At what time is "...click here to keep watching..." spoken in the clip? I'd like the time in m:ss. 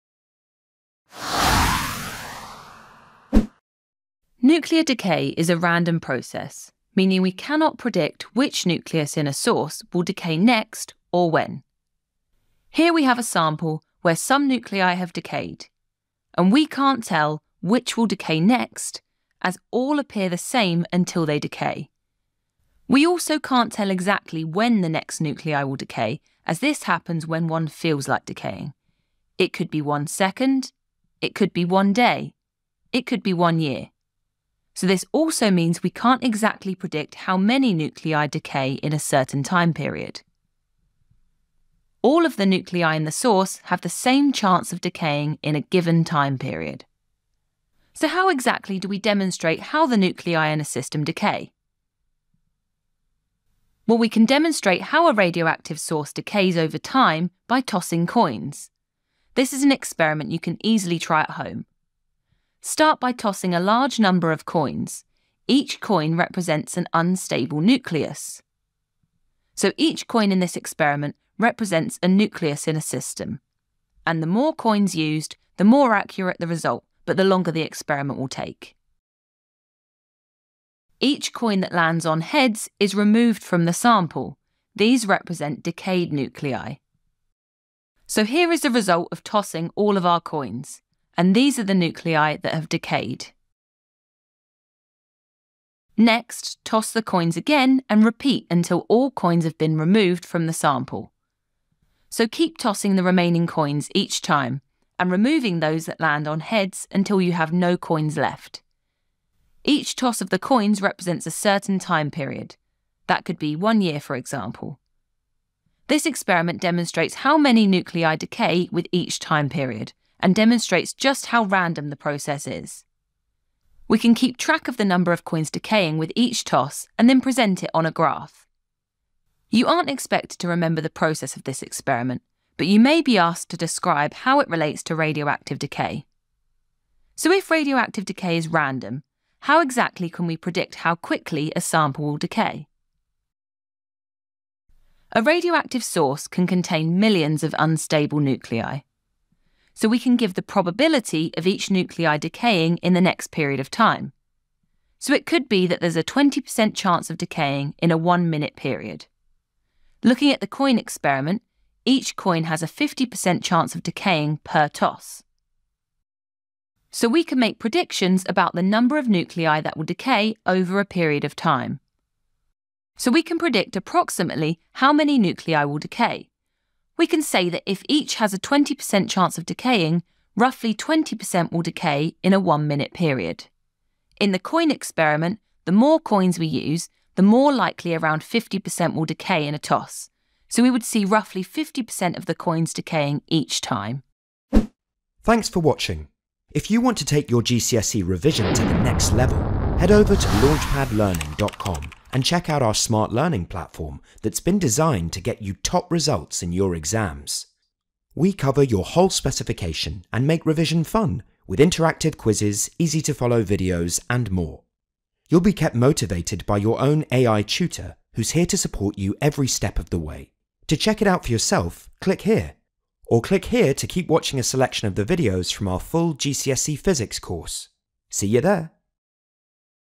3:43.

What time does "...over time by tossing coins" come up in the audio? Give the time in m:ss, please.
0:56.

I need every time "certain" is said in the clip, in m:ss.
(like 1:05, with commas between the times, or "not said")
0:38, 1:51.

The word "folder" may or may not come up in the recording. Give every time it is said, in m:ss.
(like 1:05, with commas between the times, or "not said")
not said.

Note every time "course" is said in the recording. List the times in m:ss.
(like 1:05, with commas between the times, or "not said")
3:47.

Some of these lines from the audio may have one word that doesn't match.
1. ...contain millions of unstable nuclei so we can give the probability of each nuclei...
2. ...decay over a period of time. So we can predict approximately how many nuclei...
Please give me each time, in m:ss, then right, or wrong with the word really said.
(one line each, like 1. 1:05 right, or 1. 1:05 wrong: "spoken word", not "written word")
1. 2:26 right
2. 2:49 right.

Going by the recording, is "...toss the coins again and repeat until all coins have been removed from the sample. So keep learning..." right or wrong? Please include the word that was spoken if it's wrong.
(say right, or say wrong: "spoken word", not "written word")
wrong: "tossing", not "learning".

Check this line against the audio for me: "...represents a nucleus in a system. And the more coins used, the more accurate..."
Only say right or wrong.
right.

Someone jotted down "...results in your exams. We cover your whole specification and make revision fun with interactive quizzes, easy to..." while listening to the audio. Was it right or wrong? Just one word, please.
right.